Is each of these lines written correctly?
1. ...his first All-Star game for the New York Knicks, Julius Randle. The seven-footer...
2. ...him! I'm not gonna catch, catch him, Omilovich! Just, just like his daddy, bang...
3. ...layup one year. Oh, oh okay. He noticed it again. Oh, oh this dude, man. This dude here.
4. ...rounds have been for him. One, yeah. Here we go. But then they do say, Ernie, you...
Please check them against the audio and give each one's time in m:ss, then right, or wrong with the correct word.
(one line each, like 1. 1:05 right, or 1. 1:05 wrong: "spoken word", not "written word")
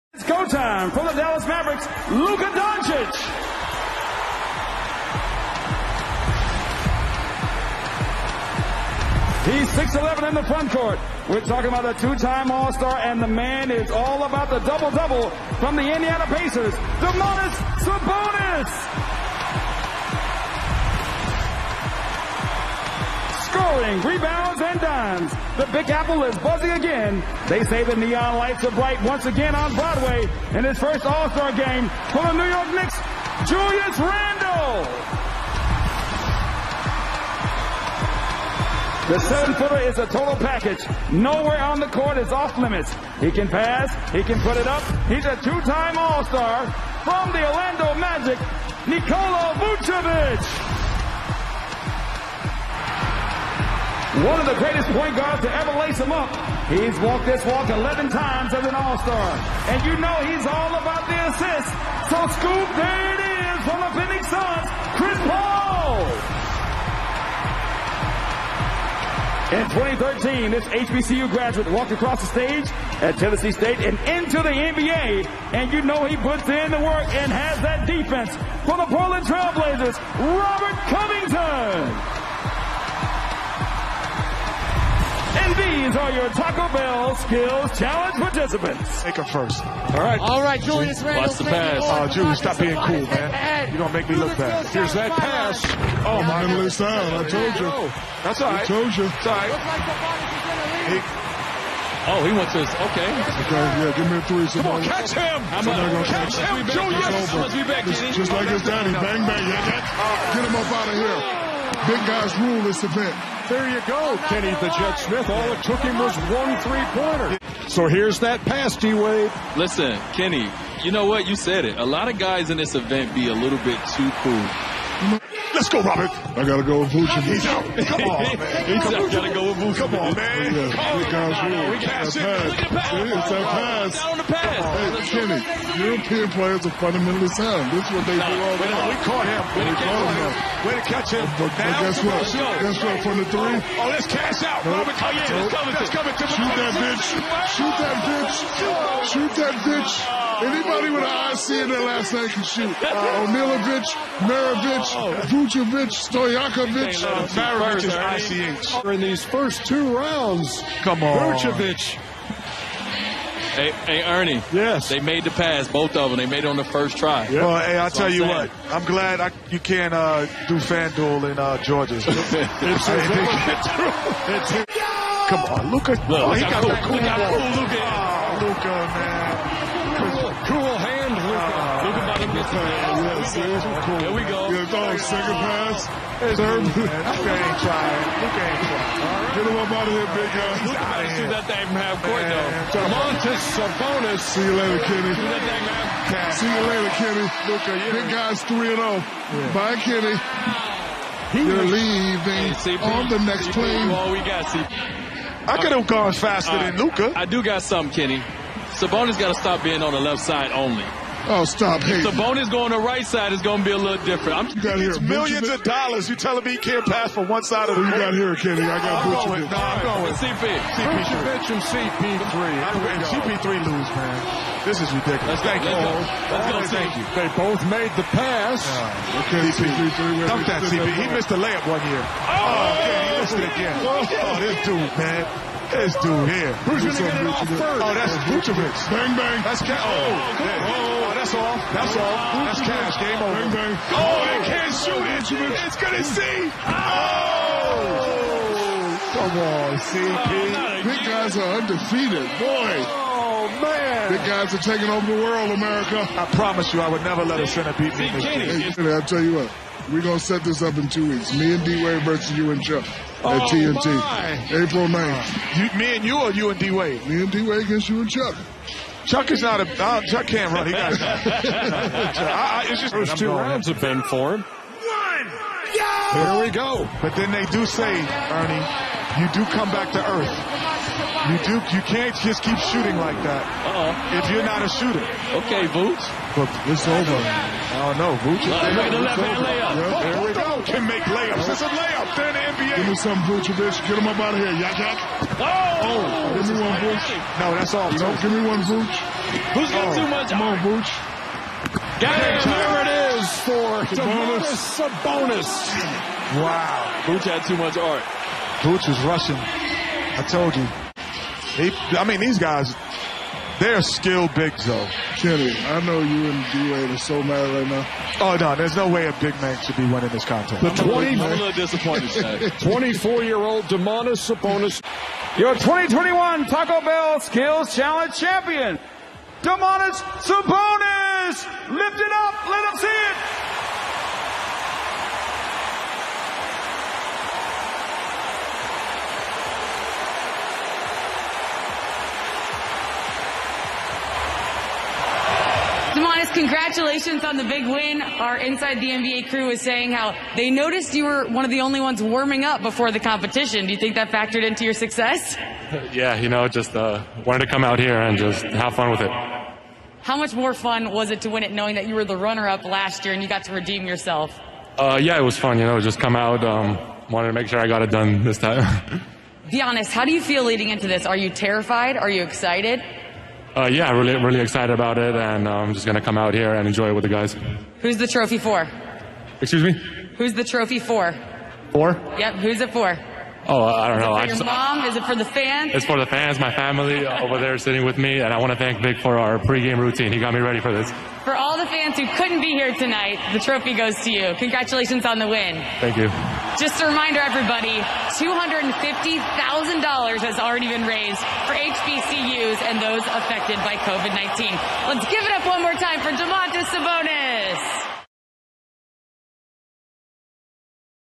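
1. 0:30 right
2. 1:45 wrong: "Julius", not "Omilovich"
3. 3:51 wrong: "missed", not "noticed"
4. 4:33 right.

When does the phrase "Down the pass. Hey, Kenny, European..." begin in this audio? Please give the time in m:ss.
2:14.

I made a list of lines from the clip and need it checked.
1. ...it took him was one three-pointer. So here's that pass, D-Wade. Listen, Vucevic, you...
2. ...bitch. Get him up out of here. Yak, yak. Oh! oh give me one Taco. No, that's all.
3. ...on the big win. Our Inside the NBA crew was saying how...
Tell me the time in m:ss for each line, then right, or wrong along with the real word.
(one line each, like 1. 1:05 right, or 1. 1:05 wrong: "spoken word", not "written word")
1. 1:55 wrong: "Kenny", not "Vucevic"
2. 4:53 wrong: "Vooch", not "Taco"
3. 5:47 right.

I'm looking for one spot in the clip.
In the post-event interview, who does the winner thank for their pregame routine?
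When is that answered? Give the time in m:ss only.
6:28.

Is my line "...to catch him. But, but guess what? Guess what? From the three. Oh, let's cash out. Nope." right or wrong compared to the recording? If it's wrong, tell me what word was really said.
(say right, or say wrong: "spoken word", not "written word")
right.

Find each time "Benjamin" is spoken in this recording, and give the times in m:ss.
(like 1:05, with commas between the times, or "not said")
3:35, 3:41.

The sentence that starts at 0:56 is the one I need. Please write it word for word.
He's walked this walk 11 times as an all-star.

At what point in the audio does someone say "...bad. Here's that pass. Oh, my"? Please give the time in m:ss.
1:34.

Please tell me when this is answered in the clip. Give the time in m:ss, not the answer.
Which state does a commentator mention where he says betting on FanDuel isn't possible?
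2:51.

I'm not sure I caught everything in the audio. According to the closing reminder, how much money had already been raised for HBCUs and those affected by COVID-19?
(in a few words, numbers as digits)
$250,000.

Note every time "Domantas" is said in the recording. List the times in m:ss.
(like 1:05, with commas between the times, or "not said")
0:16, 5:23, 5:29, 6:46.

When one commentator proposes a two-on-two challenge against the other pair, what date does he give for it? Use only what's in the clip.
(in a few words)
April 9th.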